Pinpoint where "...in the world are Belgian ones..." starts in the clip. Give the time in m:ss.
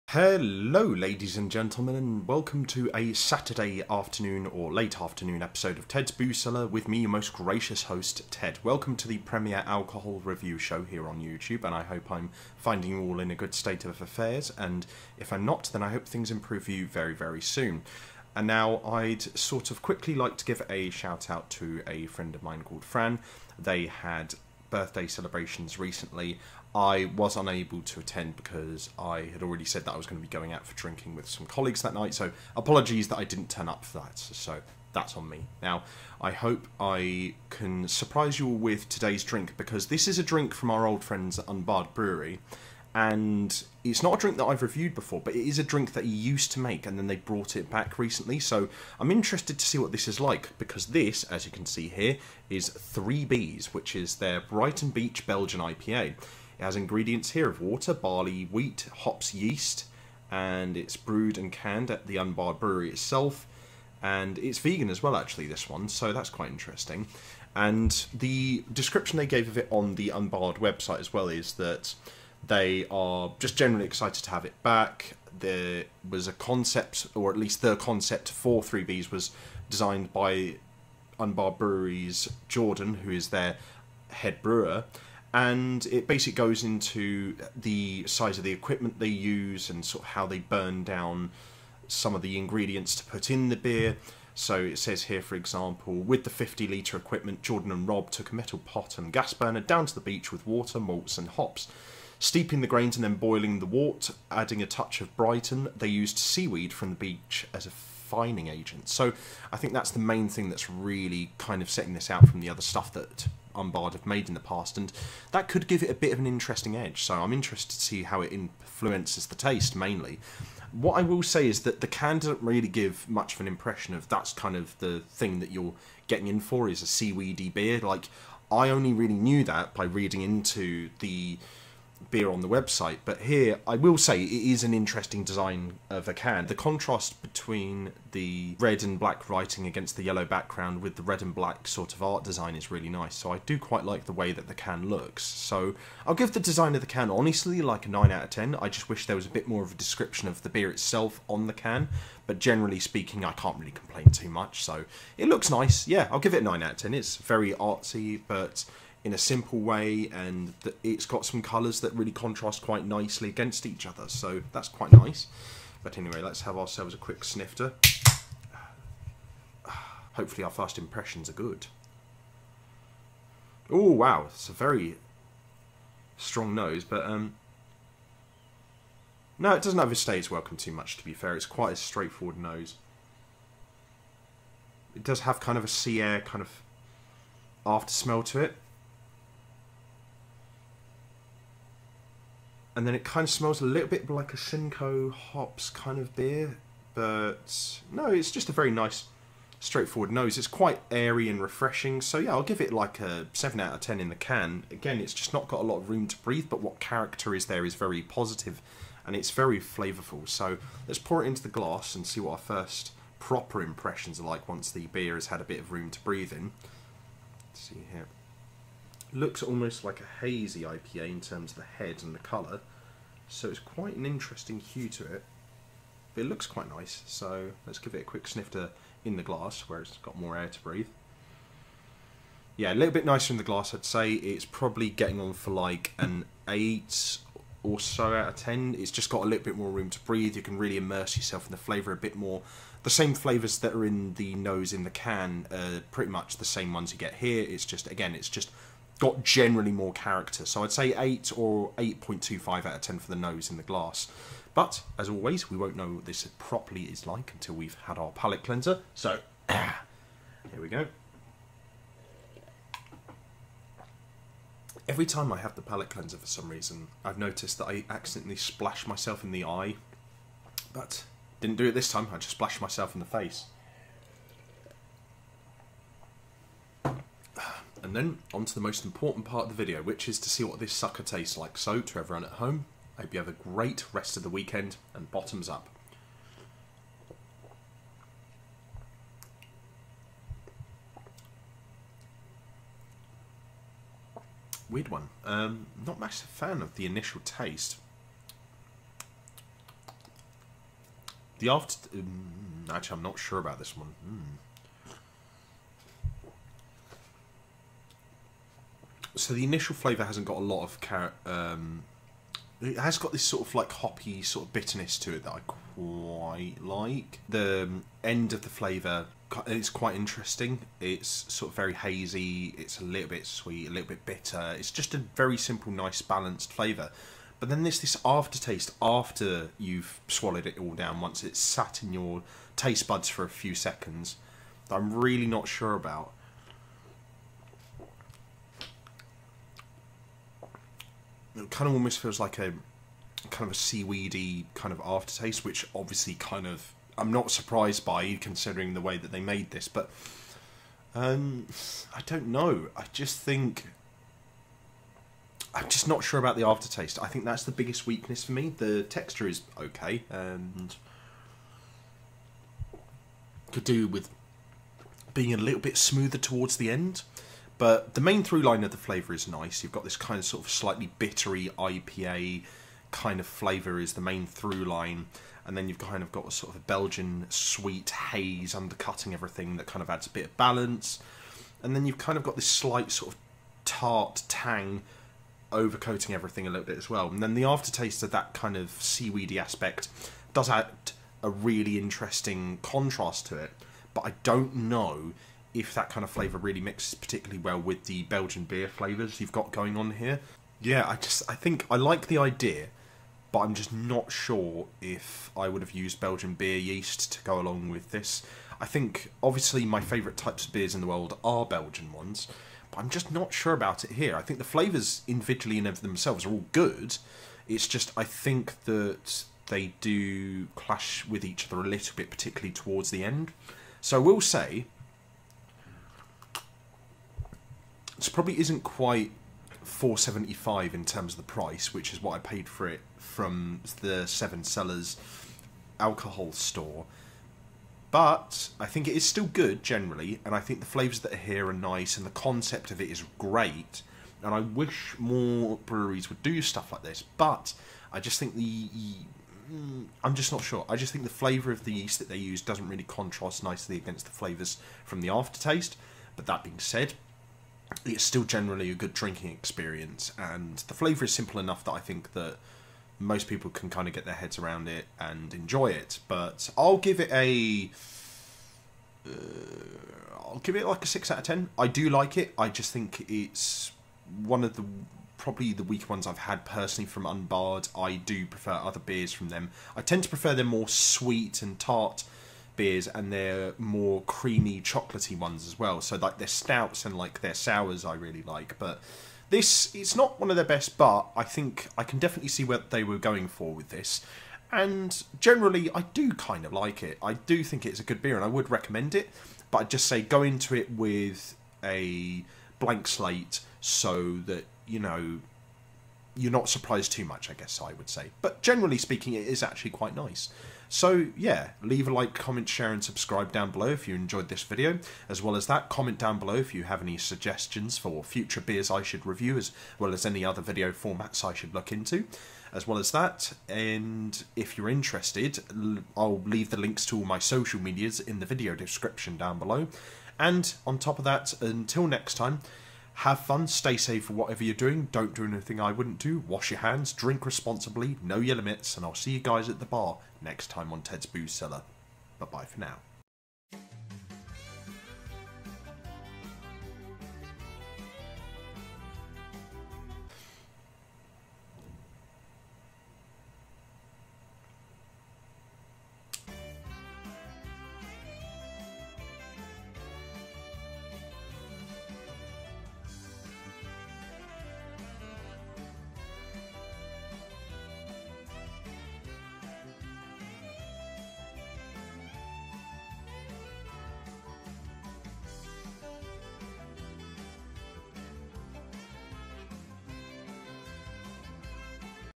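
6:50.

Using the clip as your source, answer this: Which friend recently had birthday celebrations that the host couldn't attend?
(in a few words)
Fran.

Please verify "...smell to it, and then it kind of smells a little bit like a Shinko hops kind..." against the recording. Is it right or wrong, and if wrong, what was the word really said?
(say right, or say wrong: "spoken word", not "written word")
right.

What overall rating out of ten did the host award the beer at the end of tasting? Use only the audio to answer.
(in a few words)
6.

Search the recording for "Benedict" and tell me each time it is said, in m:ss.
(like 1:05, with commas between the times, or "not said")
not said.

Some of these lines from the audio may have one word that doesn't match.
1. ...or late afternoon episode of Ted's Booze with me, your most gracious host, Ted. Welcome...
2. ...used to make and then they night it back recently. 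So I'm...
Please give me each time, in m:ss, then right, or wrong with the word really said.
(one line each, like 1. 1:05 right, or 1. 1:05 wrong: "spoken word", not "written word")
1. 0:04 right
2. 0:46 wrong: "brought", not "night".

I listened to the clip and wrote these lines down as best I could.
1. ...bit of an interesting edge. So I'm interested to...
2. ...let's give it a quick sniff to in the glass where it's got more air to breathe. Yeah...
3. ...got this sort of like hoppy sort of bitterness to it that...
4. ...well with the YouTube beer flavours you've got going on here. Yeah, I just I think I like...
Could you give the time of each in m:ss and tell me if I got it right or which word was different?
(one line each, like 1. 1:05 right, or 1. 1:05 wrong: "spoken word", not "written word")
1. 1:55 right
2. 3:47 right
3. 5:12 right
4. 6:37 wrong: "Belgian", not "YouTube".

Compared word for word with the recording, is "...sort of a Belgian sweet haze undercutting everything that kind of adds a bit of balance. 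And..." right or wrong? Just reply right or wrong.
right.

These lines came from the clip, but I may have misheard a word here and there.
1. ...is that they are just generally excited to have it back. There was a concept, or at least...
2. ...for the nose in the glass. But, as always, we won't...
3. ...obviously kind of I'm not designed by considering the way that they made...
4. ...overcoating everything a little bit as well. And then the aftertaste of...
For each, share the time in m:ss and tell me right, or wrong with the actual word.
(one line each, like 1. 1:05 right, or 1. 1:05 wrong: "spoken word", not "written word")
1. 1:11 right
2. 4:12 right
3. 5:45 wrong: "surprised", not "designed"
4. 6:25 right.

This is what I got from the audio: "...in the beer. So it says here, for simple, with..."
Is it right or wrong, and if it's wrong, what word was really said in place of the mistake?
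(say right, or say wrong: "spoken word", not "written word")
wrong: "example", not "simple".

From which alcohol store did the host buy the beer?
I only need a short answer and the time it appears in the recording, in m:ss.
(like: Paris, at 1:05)
Seven Cellars, at 7:14.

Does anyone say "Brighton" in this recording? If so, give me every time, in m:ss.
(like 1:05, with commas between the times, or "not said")
0:54, 1:45.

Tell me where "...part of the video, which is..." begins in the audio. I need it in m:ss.
4:39.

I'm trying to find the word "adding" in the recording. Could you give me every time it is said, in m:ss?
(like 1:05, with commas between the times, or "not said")
1:44.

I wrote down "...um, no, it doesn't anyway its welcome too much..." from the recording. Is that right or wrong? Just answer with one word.
wrong.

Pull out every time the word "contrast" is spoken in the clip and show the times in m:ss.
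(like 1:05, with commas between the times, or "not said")
2:16, 2:42, 6:32, 7:32.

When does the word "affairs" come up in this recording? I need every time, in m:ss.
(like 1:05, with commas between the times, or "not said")
0:14.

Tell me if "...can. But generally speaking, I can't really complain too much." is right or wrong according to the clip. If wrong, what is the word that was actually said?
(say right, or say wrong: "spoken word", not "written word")
right.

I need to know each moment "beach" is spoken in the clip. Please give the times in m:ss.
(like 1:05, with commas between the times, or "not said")
0:54, 1:40, 1:46.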